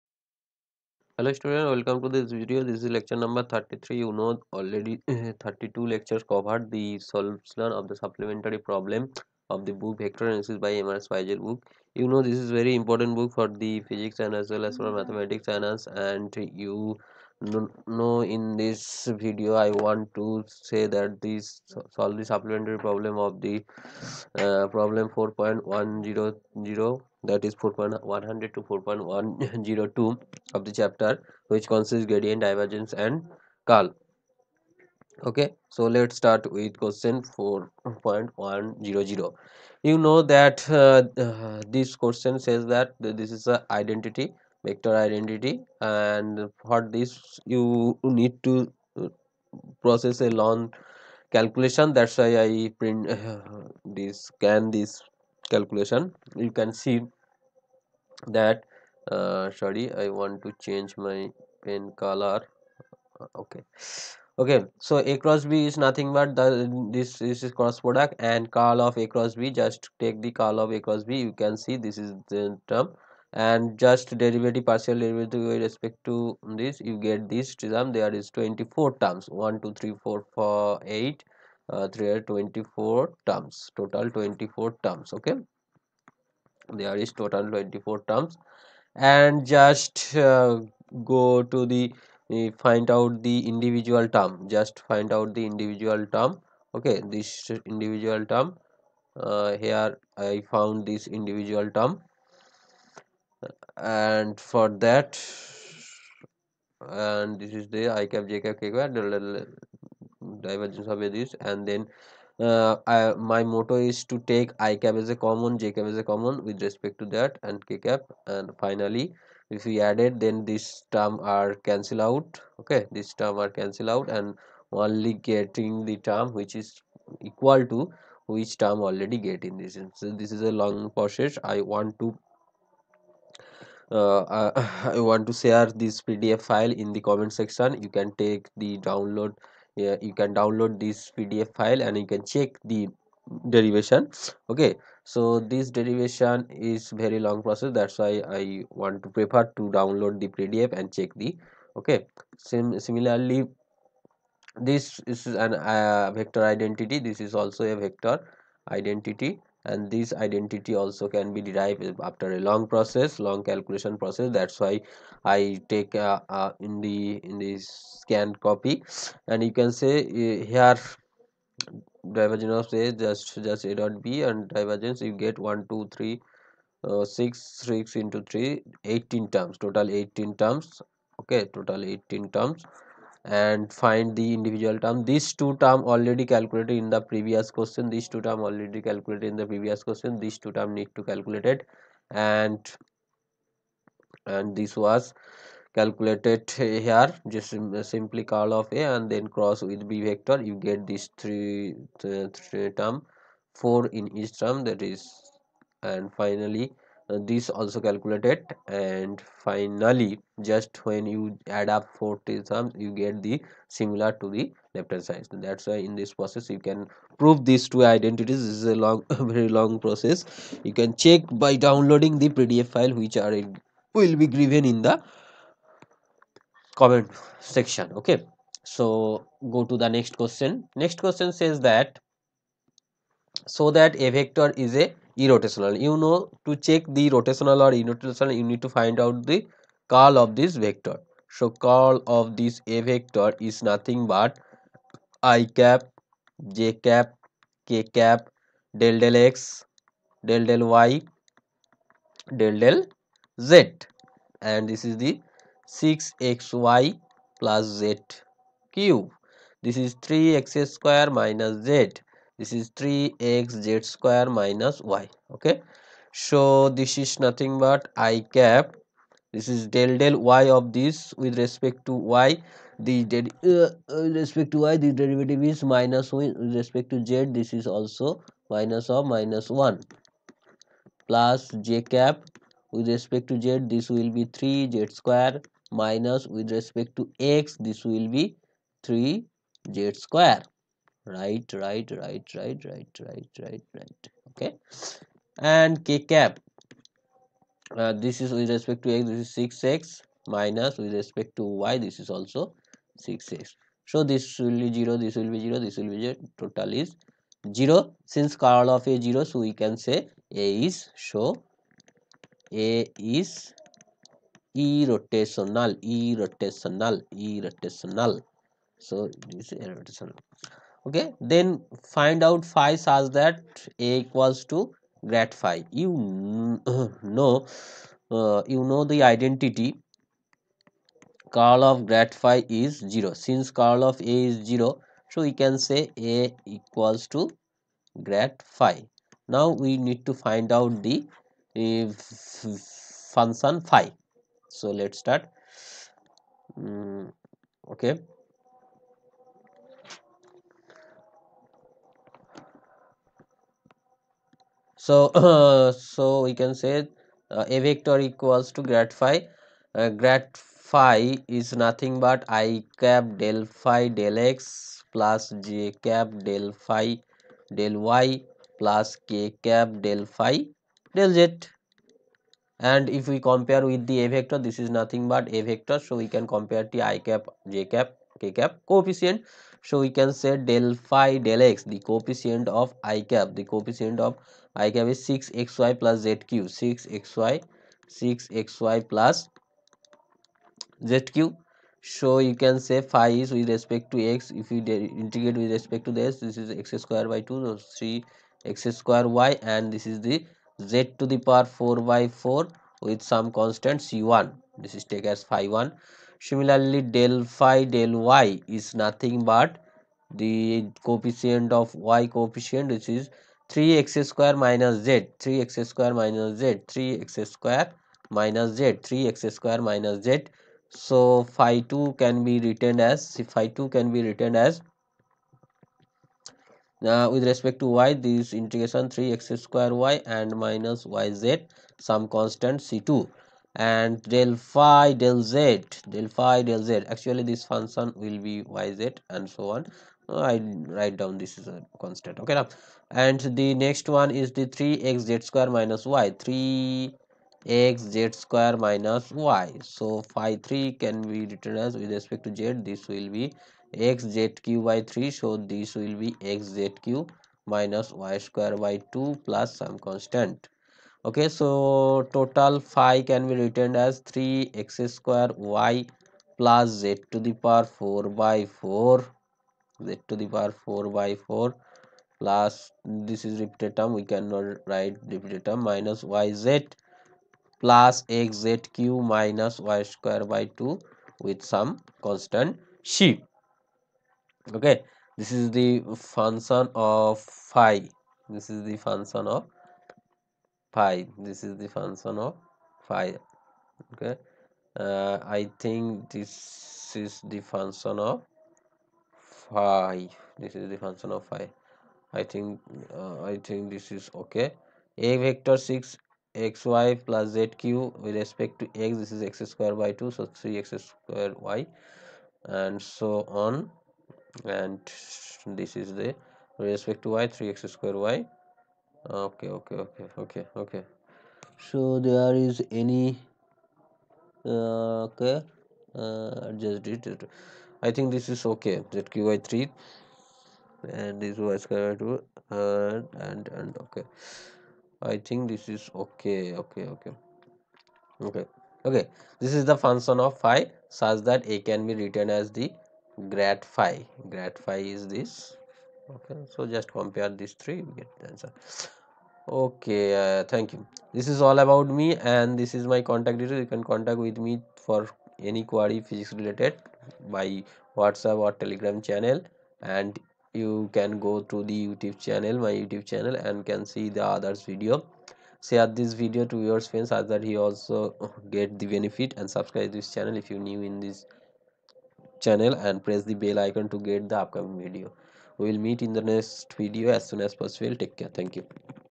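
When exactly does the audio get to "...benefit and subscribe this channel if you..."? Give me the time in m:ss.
9:28.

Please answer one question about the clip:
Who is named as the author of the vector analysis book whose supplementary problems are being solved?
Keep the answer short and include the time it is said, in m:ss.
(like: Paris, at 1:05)
M.R. Spiegel, at 0:10.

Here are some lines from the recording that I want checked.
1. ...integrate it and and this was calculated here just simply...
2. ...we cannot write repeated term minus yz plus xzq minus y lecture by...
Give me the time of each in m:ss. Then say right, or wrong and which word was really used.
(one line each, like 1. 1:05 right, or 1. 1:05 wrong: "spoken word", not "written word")
1. 3:11 wrong: "calculate", not "integrate"
2. 7:53 wrong: "square", not "lecture".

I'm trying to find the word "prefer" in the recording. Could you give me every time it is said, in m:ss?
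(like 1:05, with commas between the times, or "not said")
2:29.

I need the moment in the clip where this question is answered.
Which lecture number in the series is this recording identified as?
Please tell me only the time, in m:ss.
0:03.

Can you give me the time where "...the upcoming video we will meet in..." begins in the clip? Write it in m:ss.
9:34.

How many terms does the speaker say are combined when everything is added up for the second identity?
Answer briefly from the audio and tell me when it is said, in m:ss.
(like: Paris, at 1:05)
40, at 3:31.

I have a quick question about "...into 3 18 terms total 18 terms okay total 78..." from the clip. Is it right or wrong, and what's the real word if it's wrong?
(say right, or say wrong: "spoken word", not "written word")
wrong: "18", not "78".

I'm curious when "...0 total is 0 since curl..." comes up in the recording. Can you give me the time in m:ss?
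5:06.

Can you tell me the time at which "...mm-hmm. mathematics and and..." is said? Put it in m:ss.
0:14.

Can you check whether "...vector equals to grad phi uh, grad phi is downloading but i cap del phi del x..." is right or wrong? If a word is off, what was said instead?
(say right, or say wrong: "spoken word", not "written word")
wrong: "nothing", not "downloading".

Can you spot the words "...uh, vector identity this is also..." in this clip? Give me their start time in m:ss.
2:35.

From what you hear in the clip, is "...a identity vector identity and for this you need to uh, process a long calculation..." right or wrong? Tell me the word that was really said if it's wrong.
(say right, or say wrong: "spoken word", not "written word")
right.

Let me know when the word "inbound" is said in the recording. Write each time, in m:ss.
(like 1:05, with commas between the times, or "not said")
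not said.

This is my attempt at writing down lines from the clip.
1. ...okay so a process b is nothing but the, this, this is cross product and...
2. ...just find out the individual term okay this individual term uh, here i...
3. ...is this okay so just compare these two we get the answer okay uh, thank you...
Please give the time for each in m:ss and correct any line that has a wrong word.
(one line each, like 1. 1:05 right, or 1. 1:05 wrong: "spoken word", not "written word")
1. 1:04 wrong: "cross", not "process"
2. 1:34 right
3. 9:04 wrong: "three", not "two".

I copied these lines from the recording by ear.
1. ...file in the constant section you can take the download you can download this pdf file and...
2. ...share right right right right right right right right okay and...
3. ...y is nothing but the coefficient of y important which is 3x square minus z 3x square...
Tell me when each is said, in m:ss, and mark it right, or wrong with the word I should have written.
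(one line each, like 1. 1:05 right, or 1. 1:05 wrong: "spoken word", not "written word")
1. 2:16 wrong: "comment", not "constant"
2. 4:50 wrong: "square", not "share"
3. 6:47 wrong: "coefficient", not "important".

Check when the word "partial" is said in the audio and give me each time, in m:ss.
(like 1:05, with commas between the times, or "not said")
1:14.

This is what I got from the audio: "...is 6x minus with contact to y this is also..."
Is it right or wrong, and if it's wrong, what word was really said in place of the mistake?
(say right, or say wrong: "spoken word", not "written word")
wrong: "respect", not "contact".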